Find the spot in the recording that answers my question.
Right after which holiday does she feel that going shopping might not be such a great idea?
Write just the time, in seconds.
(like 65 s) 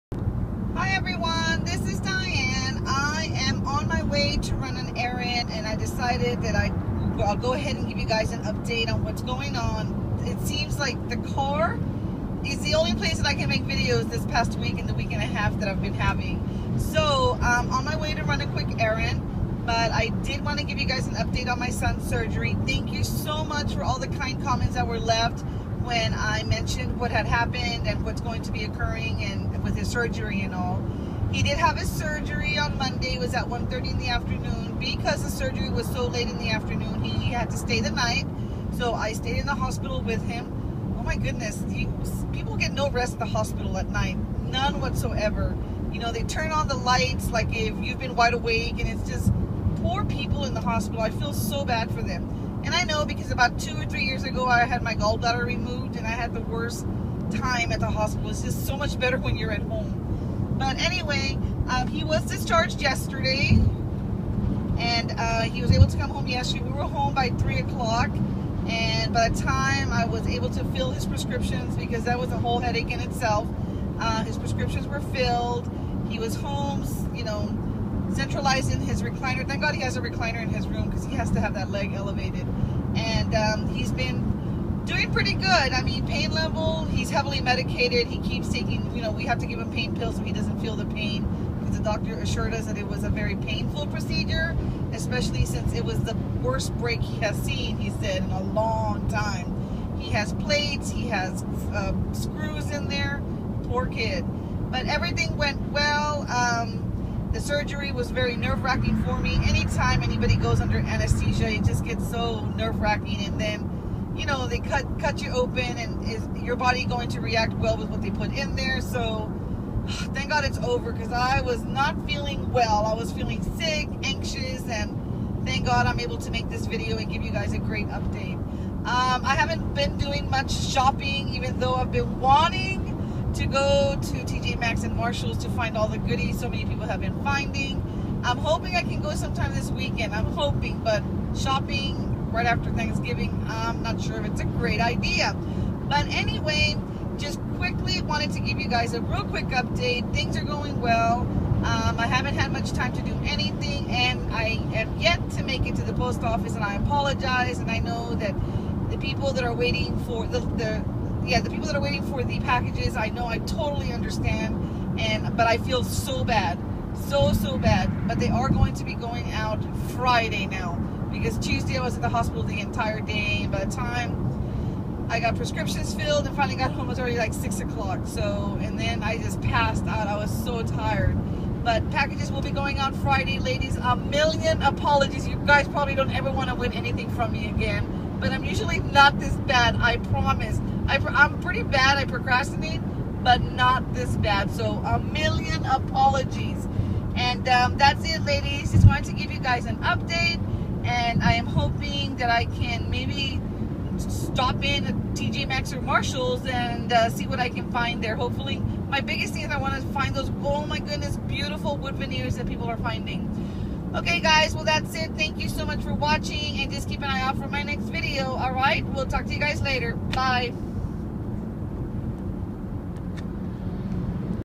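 142 s.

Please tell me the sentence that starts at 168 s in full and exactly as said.
But they are going to be going out Friday now because Tuesday I was at the hospital the entire day.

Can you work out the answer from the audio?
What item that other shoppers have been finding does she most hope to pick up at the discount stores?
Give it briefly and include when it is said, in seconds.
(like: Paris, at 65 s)
wood veneers, at 211 s.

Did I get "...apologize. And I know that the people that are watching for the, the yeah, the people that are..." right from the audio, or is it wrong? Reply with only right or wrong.
wrong.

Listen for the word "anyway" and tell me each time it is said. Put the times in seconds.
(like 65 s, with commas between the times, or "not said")
60 s, 146 s.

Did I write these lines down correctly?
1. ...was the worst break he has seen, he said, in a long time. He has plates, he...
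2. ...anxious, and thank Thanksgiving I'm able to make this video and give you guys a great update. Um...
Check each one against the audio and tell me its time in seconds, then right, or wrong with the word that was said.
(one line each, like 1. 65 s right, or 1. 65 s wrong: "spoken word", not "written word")
1. 95 s right
2. 124 s wrong: "God", not "Thanksgiving".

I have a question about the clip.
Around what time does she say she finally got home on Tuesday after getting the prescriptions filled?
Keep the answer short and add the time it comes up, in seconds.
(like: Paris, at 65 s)
6 o'clock, at 177 s.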